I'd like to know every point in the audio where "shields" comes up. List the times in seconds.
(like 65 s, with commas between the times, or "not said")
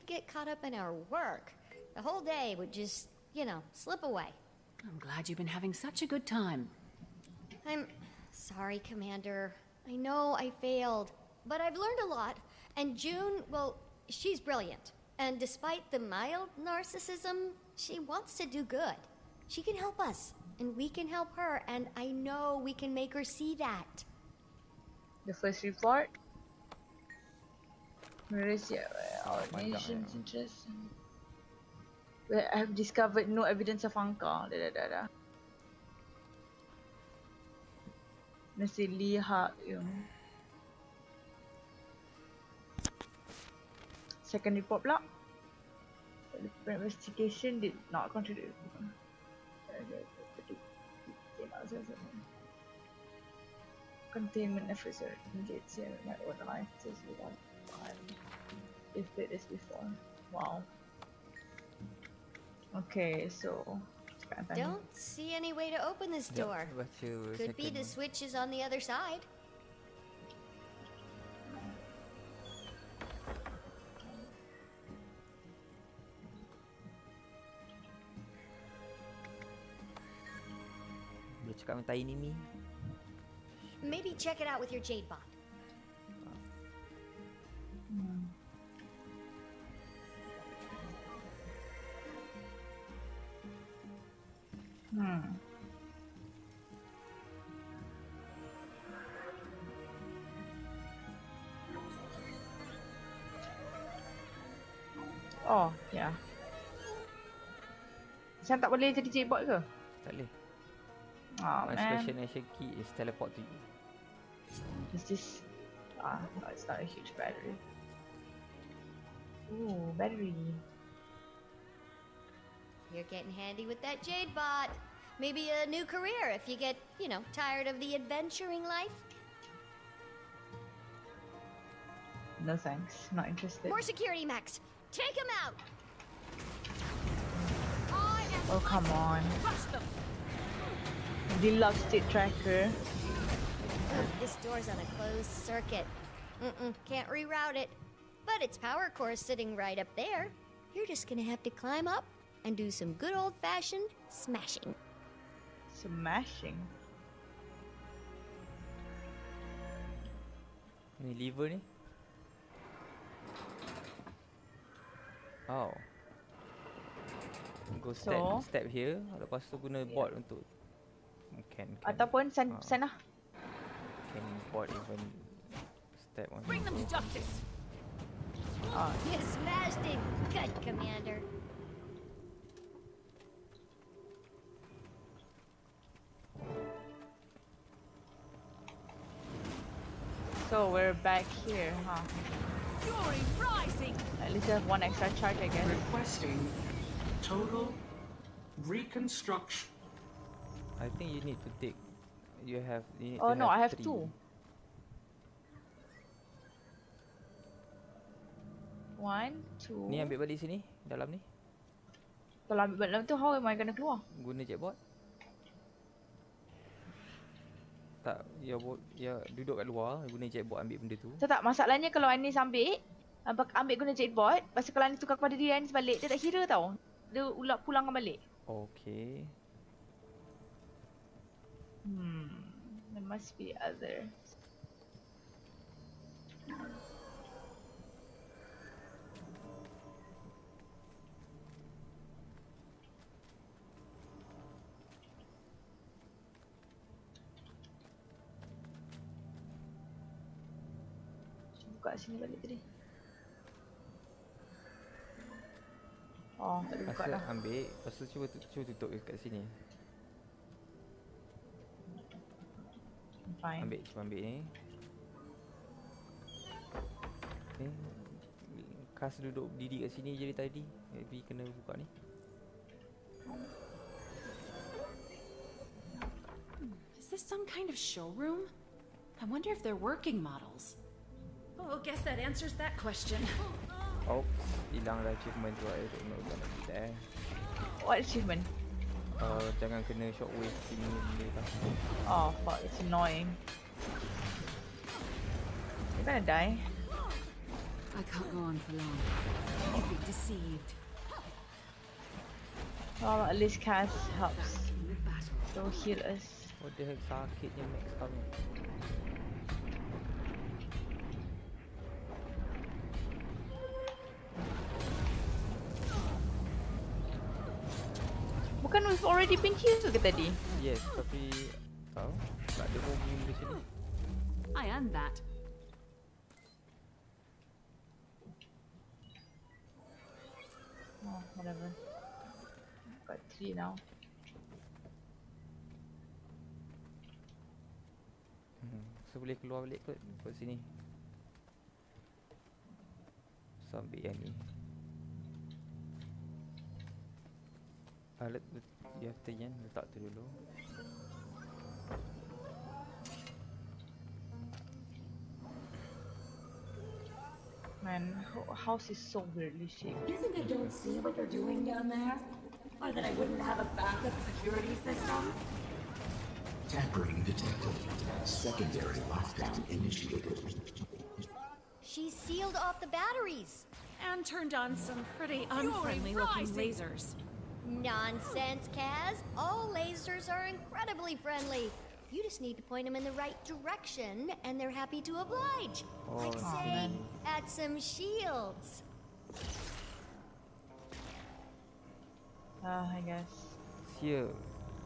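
387 s, 393 s.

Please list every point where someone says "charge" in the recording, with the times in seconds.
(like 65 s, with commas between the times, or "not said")
195 s.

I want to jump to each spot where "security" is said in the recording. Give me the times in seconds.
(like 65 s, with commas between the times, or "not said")
133 s, 364 s.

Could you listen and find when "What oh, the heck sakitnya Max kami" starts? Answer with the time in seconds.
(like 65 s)
306 s.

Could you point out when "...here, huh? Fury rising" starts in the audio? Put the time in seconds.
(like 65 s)
191 s.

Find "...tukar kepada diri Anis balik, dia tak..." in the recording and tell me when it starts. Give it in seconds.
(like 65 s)
225 s.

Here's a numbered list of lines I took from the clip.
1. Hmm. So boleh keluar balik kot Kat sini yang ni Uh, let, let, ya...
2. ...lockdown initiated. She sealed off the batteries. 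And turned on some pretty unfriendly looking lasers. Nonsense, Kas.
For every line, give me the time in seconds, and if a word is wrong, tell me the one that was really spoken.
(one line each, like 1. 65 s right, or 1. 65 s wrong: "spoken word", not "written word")
1. 338 s right
2. 369 s right.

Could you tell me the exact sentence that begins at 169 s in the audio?
Lepas tu guna board untuk can, can, Ataupun send, uh, send lah.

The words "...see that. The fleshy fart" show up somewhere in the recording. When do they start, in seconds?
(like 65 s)
23 s.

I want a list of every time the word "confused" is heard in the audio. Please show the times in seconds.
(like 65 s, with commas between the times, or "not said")
not said.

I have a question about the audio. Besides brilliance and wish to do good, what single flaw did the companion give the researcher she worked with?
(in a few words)
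mild narcissism.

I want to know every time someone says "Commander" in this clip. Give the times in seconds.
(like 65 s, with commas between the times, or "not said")
8 s, 180 s.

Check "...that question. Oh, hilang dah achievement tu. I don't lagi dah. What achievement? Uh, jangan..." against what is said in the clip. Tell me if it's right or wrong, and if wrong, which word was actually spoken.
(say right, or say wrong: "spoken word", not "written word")
right.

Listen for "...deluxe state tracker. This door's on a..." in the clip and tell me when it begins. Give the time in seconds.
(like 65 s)
141 s.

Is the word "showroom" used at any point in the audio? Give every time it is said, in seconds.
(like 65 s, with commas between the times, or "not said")
277 s.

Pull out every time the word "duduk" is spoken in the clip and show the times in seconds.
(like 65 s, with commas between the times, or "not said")
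219 s, 269 s.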